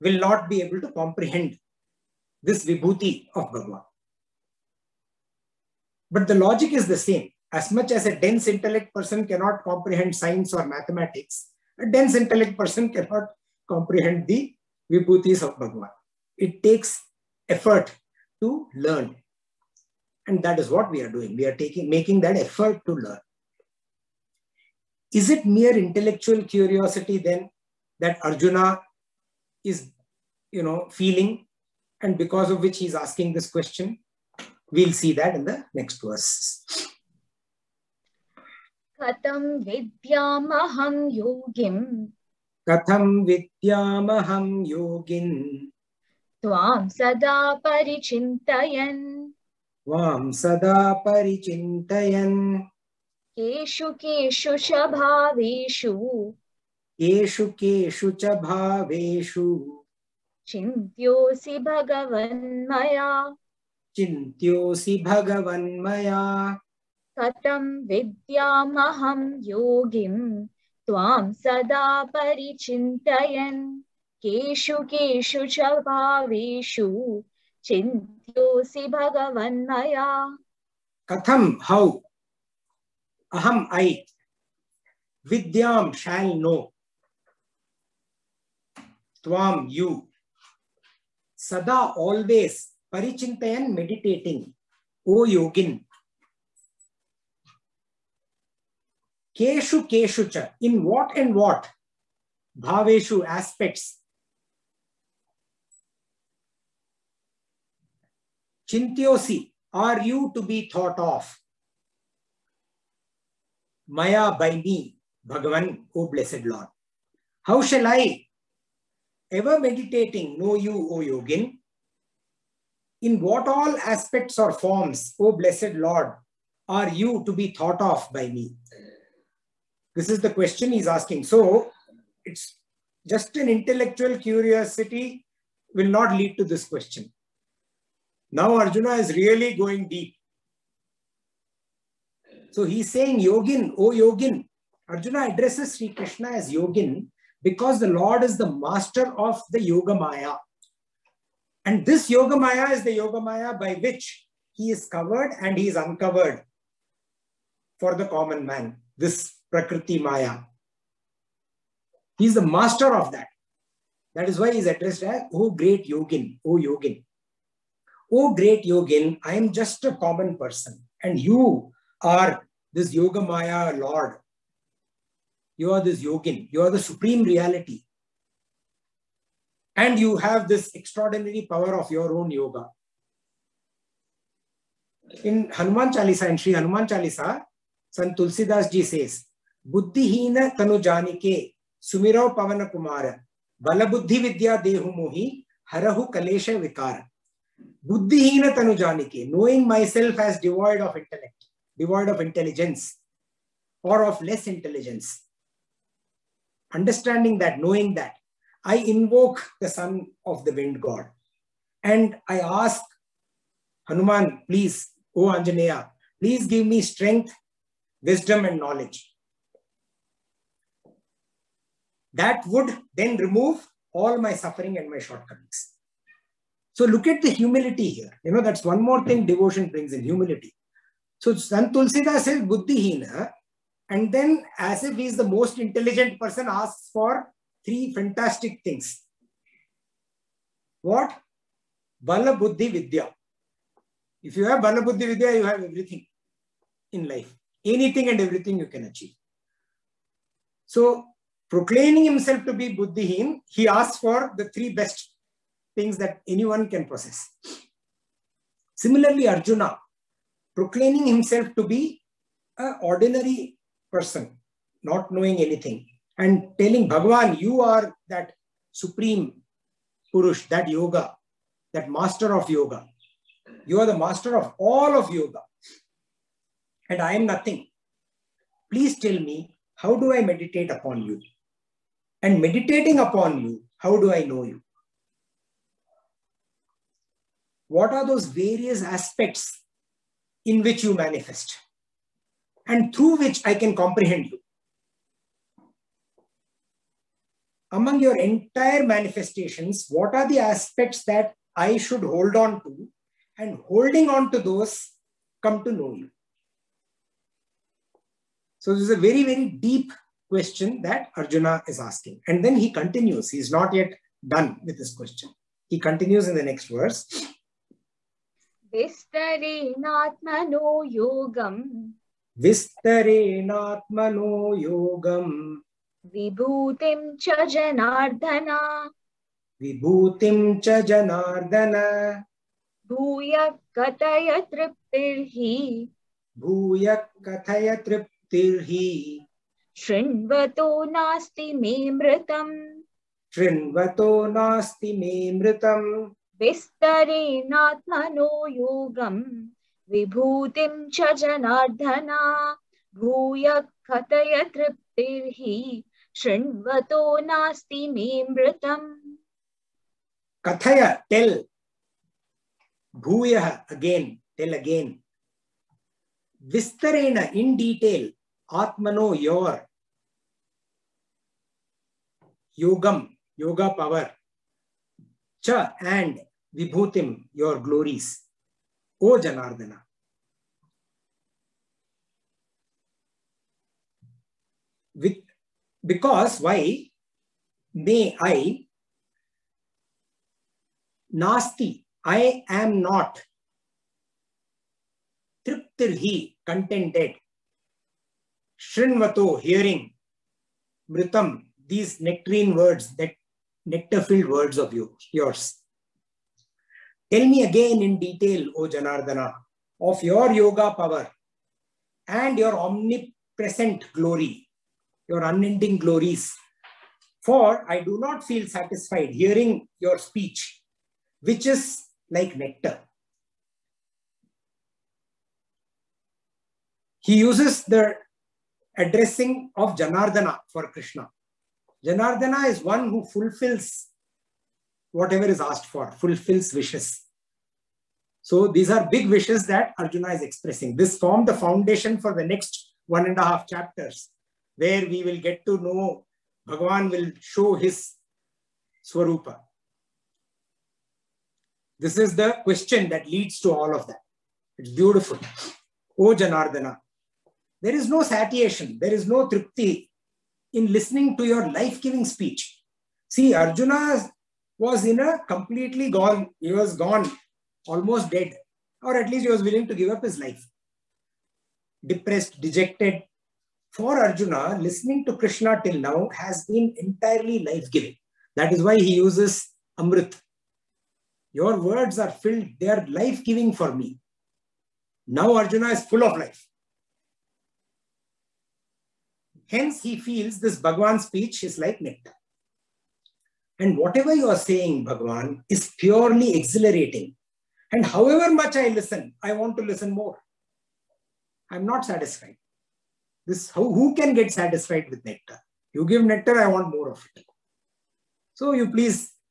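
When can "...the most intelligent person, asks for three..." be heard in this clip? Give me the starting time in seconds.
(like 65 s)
235 s.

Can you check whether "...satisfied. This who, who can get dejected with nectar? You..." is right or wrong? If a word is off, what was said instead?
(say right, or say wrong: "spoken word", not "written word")
wrong: "satisfied", not "dejected".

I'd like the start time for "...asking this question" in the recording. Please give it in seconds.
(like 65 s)
32 s.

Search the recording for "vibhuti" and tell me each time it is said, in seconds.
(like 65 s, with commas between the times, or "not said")
2 s, 14 s.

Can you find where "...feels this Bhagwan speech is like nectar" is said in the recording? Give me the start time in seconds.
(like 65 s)
489 s.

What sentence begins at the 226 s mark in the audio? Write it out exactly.
So look at the humility here.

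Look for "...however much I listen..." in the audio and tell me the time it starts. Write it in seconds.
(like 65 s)
497 s.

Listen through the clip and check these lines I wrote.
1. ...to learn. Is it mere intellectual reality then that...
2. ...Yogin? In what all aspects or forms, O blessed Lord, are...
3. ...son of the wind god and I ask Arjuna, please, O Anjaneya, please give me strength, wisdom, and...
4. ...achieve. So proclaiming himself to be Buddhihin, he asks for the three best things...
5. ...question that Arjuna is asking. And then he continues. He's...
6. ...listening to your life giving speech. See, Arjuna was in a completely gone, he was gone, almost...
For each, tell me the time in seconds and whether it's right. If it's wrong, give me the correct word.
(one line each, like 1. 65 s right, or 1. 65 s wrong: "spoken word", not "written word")
1. 22 s wrong: "curiosity", not "reality"
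2. 121 s right
3. 209 s wrong: "Hanuman", not "Arjuna"
4. 248 s right
5. 310 s right
6. 460 s right.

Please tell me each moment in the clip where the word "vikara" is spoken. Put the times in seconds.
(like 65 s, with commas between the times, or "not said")
196 s.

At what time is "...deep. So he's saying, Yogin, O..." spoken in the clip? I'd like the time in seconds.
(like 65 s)
139 s.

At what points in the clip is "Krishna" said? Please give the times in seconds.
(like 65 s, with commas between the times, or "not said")
145 s, 430 s, 475 s.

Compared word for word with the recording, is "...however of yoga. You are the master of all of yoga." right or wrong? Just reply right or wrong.
wrong.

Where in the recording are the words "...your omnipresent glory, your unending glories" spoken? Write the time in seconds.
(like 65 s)
412 s.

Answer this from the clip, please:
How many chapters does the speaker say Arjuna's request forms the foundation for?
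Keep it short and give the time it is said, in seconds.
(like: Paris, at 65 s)
1.5, at 442 s.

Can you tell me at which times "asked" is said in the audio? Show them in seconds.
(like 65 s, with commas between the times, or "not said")
435 s.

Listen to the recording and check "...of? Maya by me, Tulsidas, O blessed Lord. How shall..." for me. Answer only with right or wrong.
wrong.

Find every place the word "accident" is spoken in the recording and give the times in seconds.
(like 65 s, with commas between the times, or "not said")
not said.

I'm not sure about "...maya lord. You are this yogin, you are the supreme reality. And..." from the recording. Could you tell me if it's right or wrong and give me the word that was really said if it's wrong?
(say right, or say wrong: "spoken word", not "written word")
right.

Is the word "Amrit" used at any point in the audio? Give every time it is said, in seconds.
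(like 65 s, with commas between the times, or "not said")
479 s.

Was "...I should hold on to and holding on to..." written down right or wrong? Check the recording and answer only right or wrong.
right.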